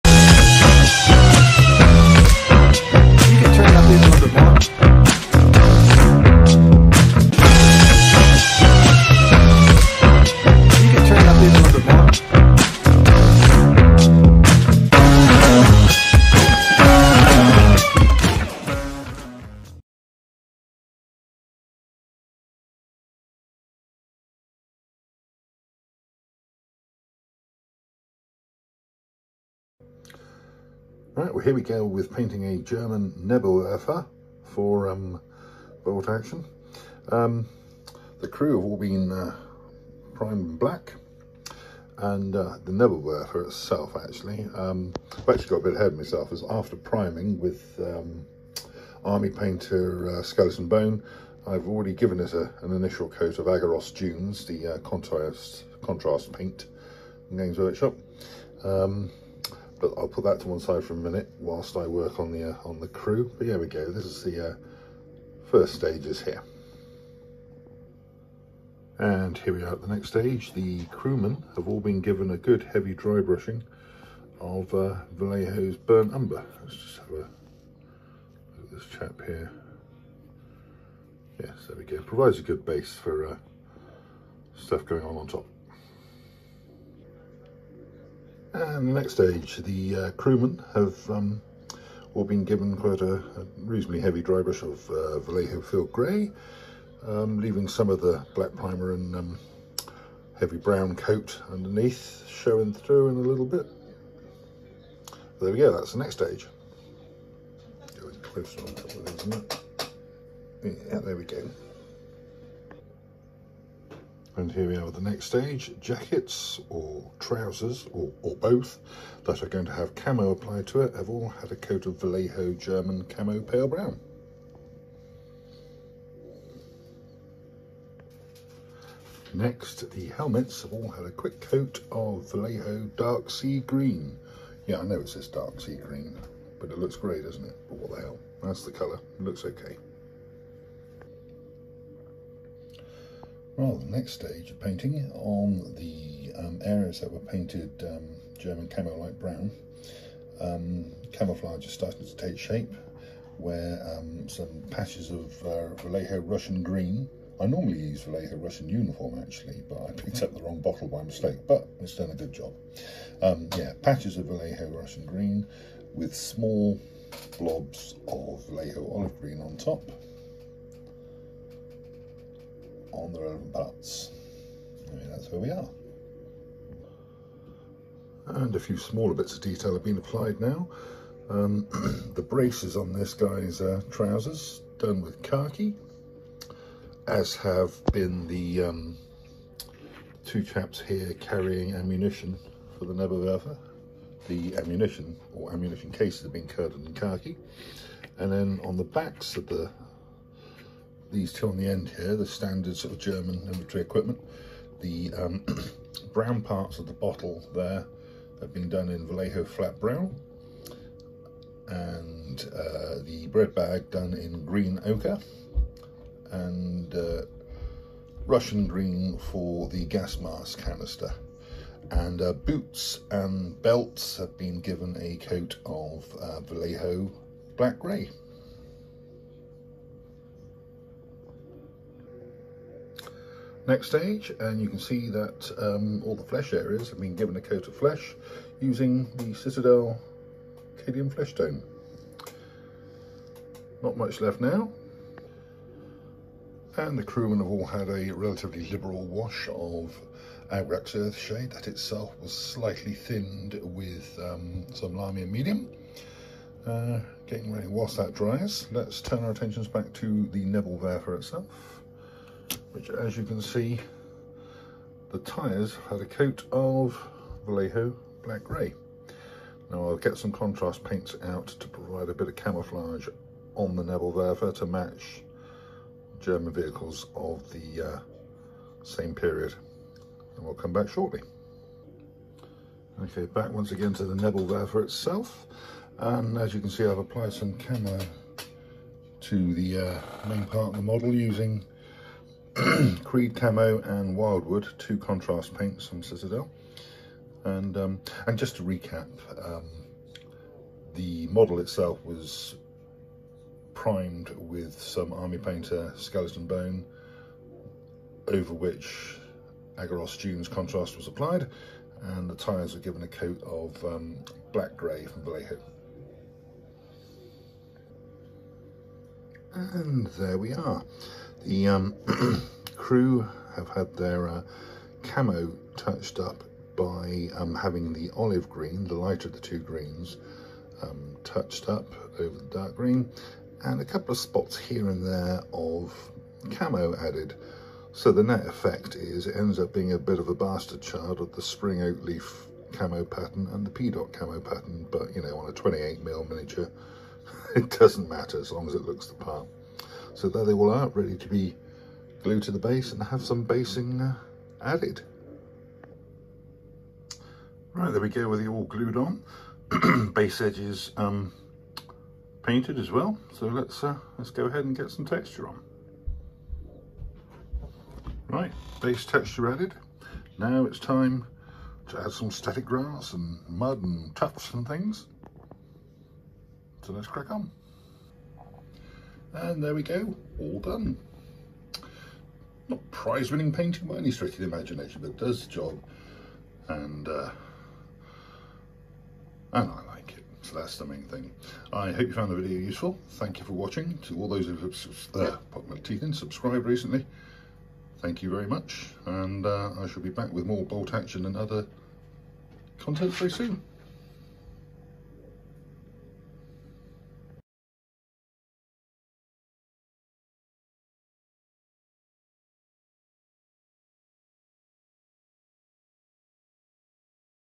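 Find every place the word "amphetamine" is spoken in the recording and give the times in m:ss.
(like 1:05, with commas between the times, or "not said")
not said.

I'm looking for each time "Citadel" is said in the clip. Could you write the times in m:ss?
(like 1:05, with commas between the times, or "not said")
3:59, 4:56.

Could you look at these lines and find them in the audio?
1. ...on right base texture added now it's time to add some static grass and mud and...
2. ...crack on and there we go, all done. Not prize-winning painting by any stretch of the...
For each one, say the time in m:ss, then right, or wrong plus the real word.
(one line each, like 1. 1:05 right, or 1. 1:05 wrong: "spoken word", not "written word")
1. 6:05 right
2. 6:17 right.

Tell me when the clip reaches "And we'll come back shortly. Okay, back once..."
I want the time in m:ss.
4:40.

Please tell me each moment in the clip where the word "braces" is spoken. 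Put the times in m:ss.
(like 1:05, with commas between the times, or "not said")
3:02.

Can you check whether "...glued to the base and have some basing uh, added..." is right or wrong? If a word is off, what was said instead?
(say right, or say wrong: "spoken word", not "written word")
right.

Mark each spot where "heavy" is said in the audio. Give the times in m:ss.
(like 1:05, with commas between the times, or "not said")
1:12, 1:34, 1:40.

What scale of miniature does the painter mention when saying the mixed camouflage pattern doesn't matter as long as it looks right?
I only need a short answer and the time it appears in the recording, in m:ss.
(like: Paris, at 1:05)
28mm, at 5:45.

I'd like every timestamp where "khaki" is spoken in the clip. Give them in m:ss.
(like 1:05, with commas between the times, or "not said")
3:05, 3:16.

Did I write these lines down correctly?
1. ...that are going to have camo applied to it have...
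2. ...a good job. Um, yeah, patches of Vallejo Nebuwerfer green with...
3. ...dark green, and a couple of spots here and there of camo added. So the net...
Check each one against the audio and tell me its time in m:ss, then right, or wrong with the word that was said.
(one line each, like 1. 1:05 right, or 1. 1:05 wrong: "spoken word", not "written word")
1. 1:59 right
2. 2:42 wrong: "Russian", not "Nebuwerfer"
3. 5:32 right.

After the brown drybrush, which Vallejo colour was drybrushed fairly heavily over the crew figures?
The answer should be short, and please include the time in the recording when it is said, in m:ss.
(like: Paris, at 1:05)
Field Grey, at 1:35.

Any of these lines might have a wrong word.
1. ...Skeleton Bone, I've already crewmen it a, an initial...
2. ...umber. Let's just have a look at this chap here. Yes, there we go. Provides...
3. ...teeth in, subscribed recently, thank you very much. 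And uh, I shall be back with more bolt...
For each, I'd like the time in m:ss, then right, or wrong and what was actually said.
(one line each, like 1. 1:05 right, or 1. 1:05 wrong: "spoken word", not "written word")
1. 0:50 wrong: "given", not "crewmen"
2. 1:16 right
3. 6:35 right.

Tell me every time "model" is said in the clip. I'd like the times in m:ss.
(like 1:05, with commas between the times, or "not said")
4:50, 5:01.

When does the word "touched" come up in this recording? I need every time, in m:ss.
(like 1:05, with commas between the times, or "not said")
5:25, 5:31.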